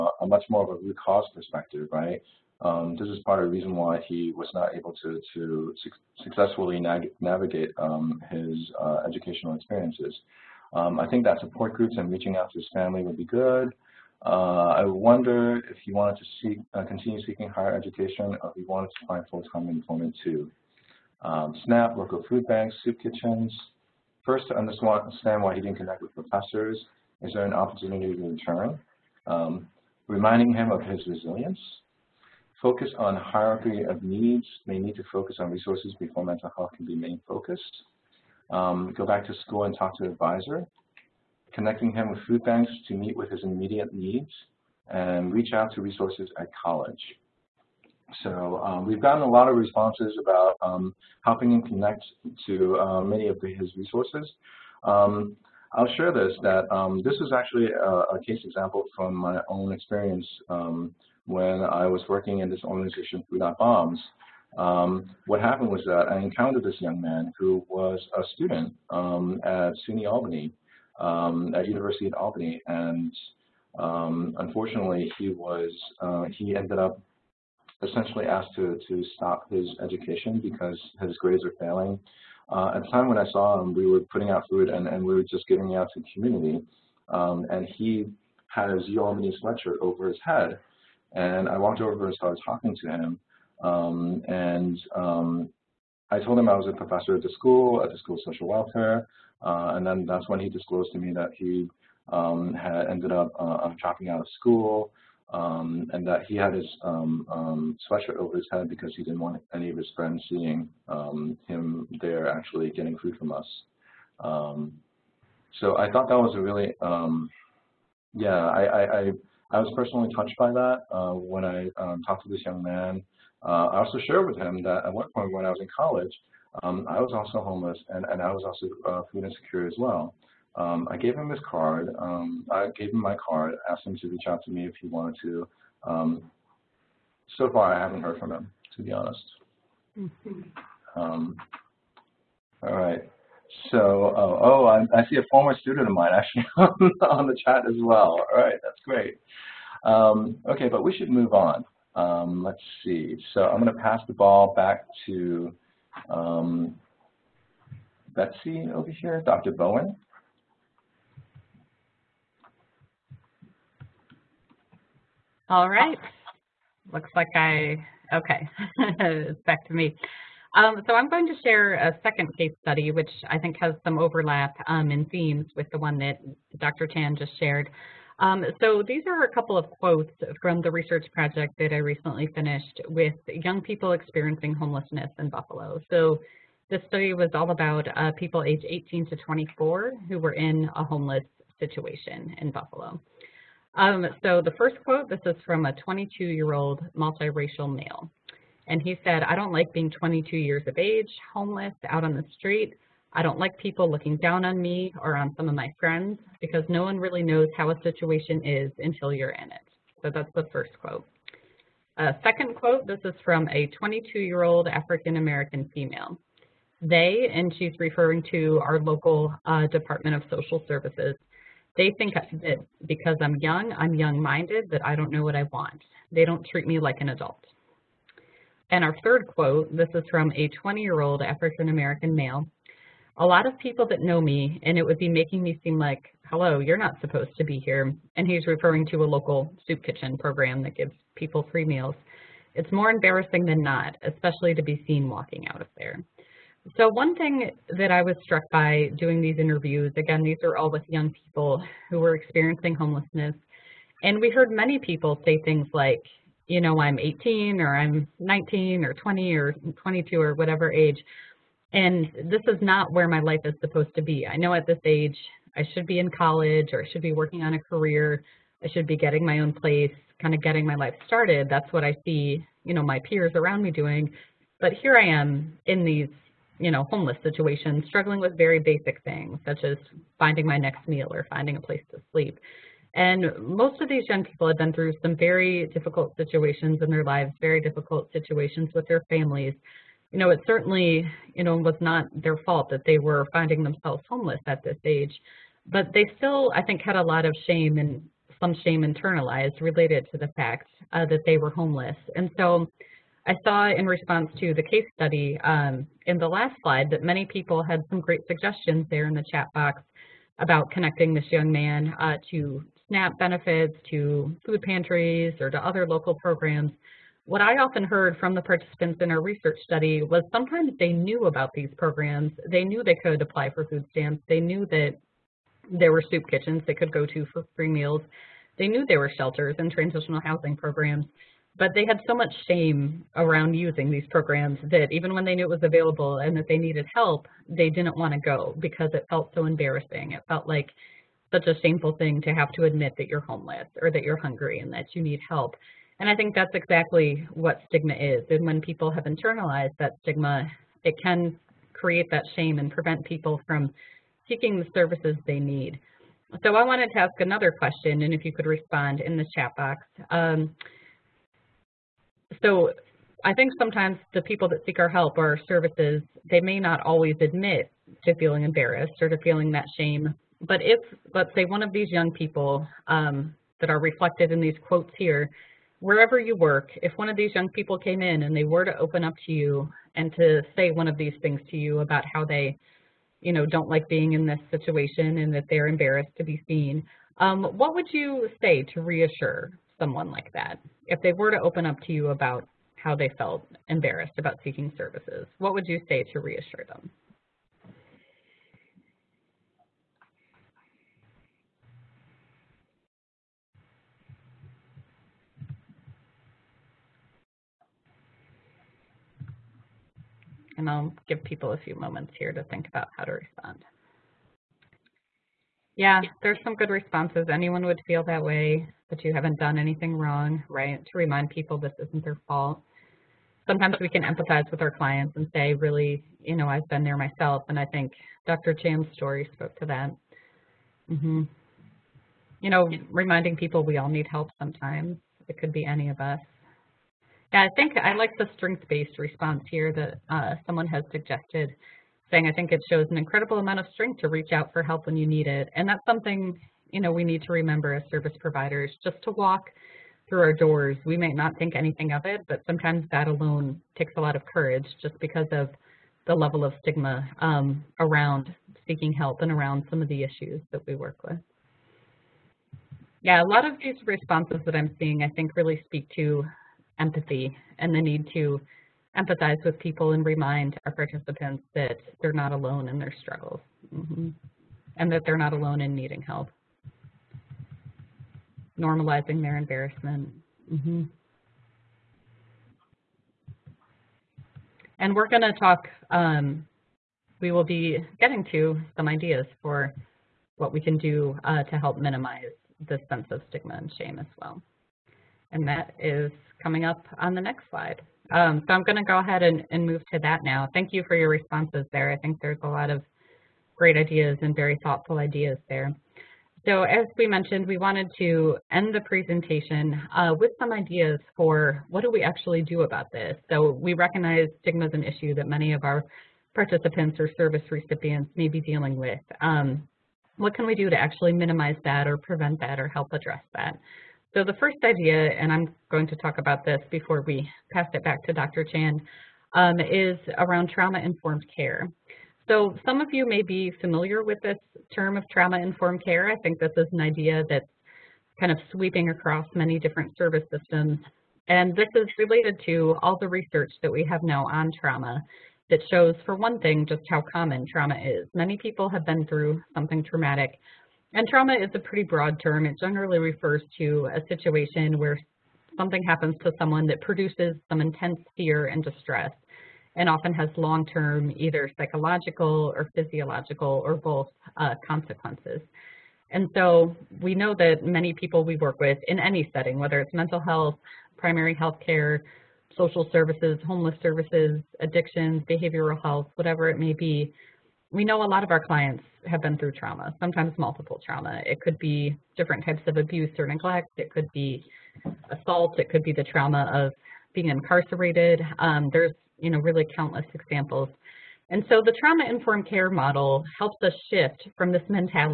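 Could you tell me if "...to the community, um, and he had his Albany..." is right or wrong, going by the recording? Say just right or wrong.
right.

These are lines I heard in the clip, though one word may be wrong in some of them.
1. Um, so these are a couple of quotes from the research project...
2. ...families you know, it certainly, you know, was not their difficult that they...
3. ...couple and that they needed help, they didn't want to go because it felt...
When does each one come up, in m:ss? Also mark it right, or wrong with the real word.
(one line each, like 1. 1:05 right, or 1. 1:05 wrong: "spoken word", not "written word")
1. 2:58 right
2. 4:49 wrong: "fault", not "difficult"
3. 5:35 wrong: "available", not "couple".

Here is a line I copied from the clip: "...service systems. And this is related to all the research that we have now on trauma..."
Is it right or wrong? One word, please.
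right.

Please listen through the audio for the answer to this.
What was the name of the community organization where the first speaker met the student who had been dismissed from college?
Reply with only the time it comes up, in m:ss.
1:03.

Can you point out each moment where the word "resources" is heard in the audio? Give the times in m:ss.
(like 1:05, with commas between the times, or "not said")
0:35, 0:45, 0:53.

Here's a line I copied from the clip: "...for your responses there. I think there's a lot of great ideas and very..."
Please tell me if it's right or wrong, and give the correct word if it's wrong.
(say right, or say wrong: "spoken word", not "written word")
right.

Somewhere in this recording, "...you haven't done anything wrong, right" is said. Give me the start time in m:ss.
6:59.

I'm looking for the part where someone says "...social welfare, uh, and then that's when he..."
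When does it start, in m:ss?
1:38.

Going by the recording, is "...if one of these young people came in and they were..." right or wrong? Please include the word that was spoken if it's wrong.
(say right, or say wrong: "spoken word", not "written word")
right.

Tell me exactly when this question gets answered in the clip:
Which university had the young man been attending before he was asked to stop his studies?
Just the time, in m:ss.
1:09.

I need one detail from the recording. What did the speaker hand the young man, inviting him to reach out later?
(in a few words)
his card.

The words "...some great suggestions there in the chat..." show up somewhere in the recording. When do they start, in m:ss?
5:07.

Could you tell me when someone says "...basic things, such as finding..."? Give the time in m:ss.
4:38.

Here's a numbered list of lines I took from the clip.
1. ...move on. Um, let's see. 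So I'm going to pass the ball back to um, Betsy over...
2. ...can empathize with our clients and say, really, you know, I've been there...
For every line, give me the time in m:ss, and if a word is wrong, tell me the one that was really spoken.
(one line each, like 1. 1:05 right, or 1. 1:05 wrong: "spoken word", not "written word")
1. 2:31 right
2. 7:03 right.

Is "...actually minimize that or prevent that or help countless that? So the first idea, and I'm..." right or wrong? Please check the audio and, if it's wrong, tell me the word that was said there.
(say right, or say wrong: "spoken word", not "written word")
wrong: "address", not "countless".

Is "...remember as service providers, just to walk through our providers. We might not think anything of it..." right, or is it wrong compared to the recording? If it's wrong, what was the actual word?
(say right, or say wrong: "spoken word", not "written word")
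wrong: "doors", not "providers".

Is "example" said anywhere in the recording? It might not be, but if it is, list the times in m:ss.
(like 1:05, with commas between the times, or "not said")
0:58, 9:50.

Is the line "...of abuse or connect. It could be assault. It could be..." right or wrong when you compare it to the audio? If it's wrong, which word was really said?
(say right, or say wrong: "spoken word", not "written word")
wrong: "neglect", not "connect".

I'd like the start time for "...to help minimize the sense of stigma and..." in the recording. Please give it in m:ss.
8:11.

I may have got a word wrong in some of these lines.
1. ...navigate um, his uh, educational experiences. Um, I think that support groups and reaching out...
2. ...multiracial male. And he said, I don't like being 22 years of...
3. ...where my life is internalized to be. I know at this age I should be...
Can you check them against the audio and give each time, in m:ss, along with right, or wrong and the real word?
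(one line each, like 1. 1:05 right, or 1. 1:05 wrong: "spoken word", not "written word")
1. 0:07 right
2. 3:16 right
3. 4:22 wrong: "supposed", not "internalized".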